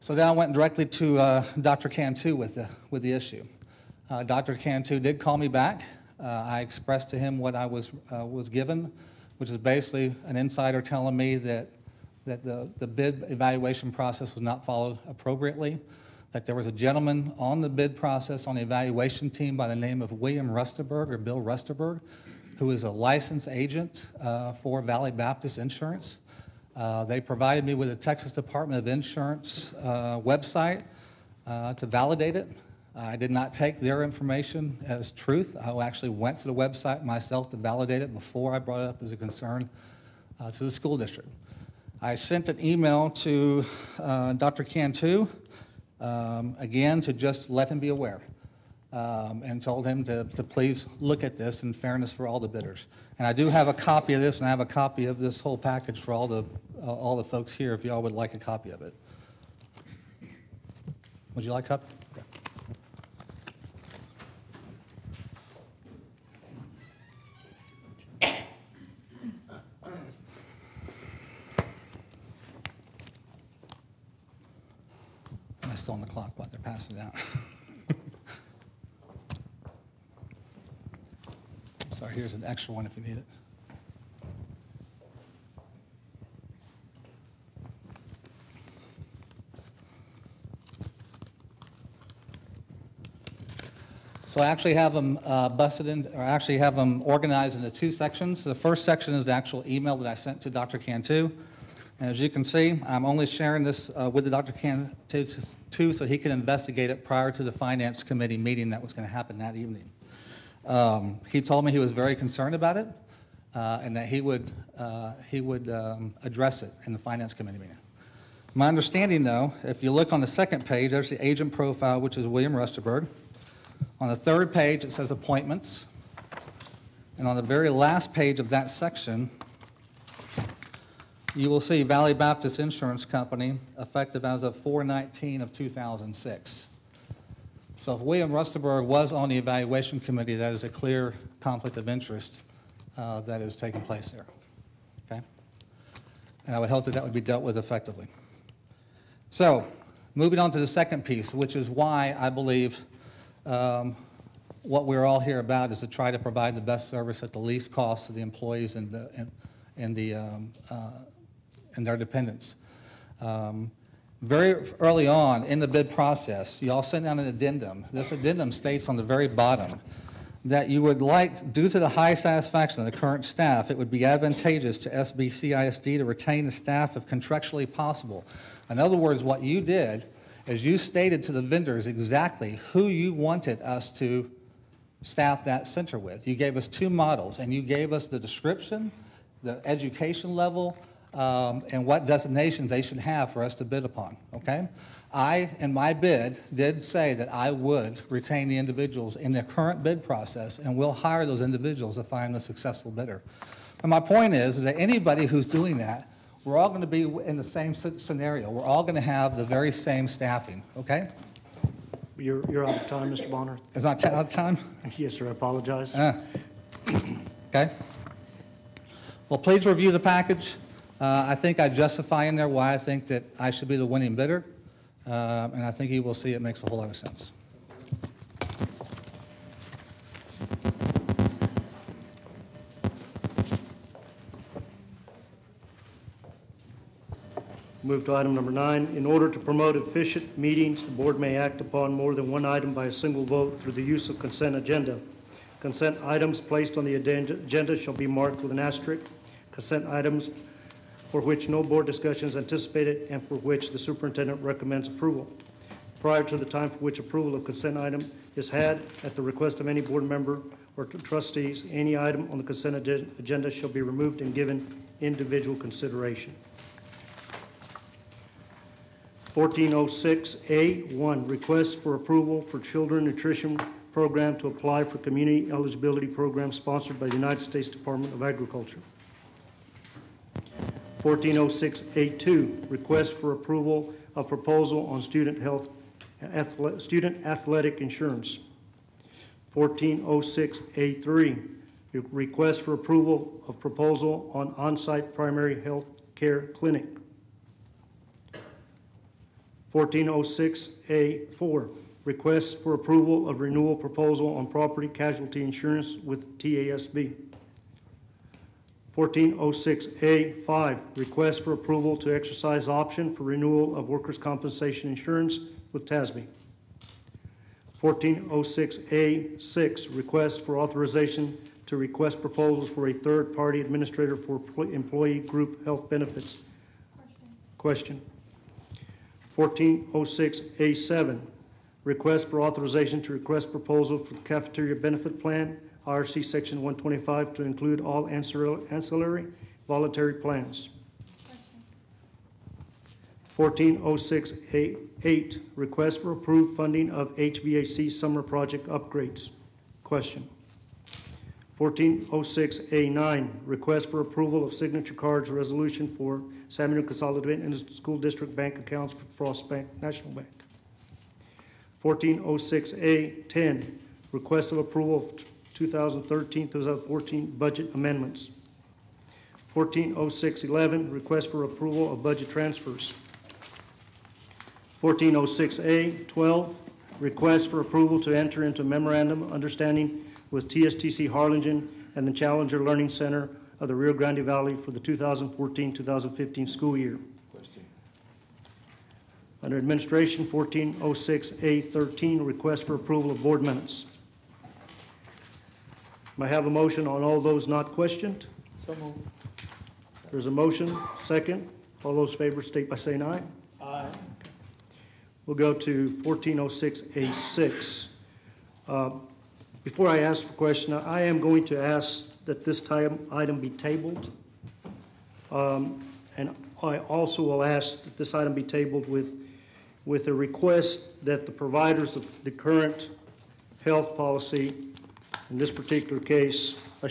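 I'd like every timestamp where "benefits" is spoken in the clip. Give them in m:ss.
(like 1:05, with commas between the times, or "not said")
5:25, 5:34.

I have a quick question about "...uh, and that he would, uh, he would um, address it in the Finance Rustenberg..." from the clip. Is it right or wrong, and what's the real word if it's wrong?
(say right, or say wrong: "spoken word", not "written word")
wrong: "Committee", not "Rustenberg".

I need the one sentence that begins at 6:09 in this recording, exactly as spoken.
140611, request for approval of budget transfers.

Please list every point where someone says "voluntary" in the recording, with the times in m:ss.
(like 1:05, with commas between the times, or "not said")
5:39.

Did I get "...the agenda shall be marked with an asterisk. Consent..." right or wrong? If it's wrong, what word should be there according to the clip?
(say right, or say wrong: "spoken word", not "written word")
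right.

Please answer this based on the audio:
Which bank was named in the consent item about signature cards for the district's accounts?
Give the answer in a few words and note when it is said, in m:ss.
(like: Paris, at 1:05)
Frost Bank, at 5:59.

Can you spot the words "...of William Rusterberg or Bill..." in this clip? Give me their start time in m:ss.
0:19.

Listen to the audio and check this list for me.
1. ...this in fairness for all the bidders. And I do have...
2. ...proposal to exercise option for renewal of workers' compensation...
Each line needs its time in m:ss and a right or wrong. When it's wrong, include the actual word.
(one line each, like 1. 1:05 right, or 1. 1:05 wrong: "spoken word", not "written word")
1. 0:51 right
2. 5:11 wrong: "approval", not "proposal".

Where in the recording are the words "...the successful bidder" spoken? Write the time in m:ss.
3:22.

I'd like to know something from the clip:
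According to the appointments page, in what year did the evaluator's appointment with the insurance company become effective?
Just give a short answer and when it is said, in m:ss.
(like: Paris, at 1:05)
2006, at 2:15.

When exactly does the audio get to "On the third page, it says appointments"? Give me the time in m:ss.
2:03.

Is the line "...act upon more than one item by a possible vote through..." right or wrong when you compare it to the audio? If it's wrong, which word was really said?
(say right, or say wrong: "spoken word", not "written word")
wrong: "single", not "possible".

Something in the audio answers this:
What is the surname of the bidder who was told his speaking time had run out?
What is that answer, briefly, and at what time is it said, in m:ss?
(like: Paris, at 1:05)
Bonner, at 3:33.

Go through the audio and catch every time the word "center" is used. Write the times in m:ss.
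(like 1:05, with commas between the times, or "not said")
3:05, 6:22.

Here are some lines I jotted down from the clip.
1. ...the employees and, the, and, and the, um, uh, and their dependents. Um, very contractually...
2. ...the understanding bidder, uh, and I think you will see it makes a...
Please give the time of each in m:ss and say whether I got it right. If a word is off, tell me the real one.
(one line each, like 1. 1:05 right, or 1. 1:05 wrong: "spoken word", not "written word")
1. 2:38 wrong: "early", not "contractually"
2. 3:43 wrong: "winning", not "understanding".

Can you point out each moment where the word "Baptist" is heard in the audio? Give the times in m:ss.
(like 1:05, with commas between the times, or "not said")
0:25, 2:12.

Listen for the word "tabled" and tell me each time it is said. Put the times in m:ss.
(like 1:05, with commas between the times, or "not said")
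6:53, 6:58.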